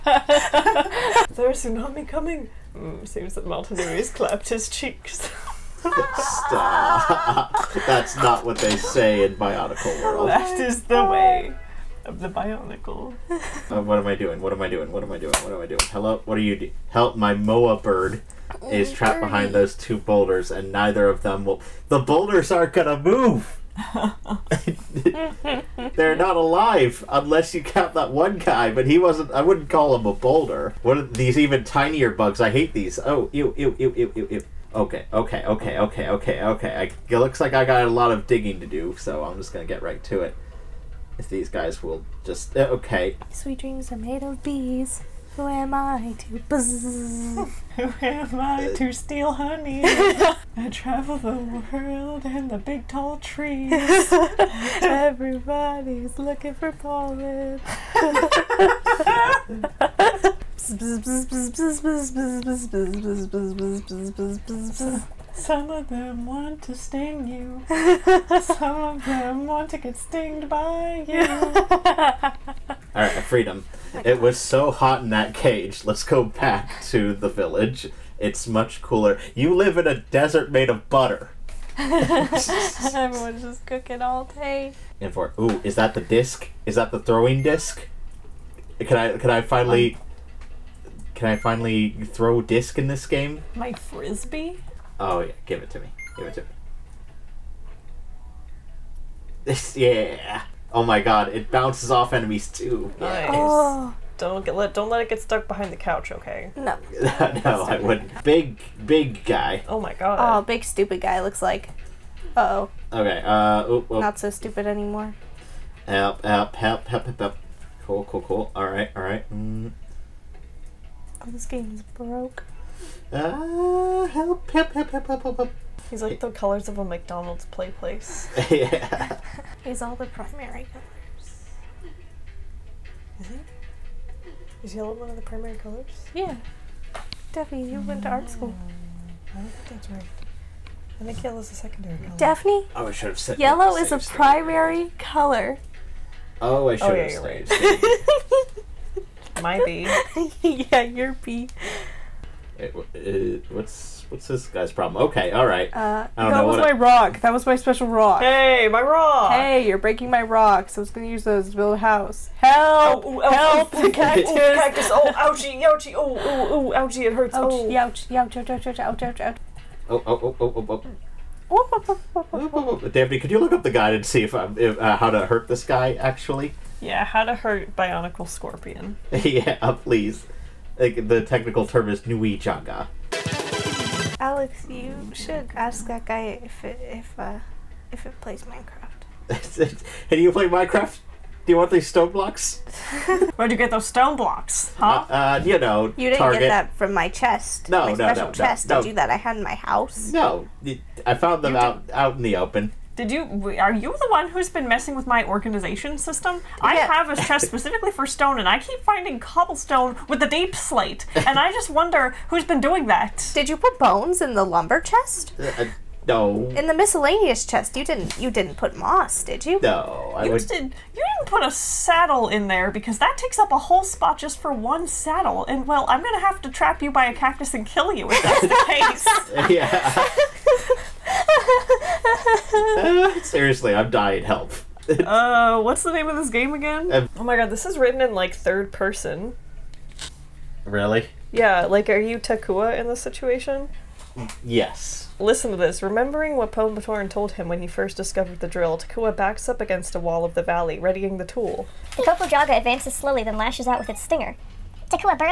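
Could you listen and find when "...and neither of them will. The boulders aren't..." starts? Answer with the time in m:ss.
0:20.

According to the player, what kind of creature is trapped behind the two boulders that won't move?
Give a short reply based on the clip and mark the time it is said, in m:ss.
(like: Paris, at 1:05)
Moa bird, at 0:17.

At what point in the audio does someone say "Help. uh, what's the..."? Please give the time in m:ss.
3:54.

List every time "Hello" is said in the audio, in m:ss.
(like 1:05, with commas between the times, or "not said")
0:15.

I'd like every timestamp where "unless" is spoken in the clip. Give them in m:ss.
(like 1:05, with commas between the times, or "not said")
0:27.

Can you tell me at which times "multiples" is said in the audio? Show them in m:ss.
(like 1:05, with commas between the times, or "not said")
not said.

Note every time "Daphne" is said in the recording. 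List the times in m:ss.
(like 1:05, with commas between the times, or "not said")
2:17, 2:22, 2:52.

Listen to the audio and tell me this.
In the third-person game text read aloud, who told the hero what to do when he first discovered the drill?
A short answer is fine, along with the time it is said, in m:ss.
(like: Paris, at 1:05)
Pombatorn, at 4:06.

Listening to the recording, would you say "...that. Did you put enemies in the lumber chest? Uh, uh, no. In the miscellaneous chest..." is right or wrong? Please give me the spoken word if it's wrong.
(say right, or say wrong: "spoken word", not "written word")
wrong: "bones", not "enemies".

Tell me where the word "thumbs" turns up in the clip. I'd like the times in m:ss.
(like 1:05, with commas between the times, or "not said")
not said.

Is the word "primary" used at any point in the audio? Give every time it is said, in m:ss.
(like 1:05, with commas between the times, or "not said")
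2:10, 2:15, 2:23.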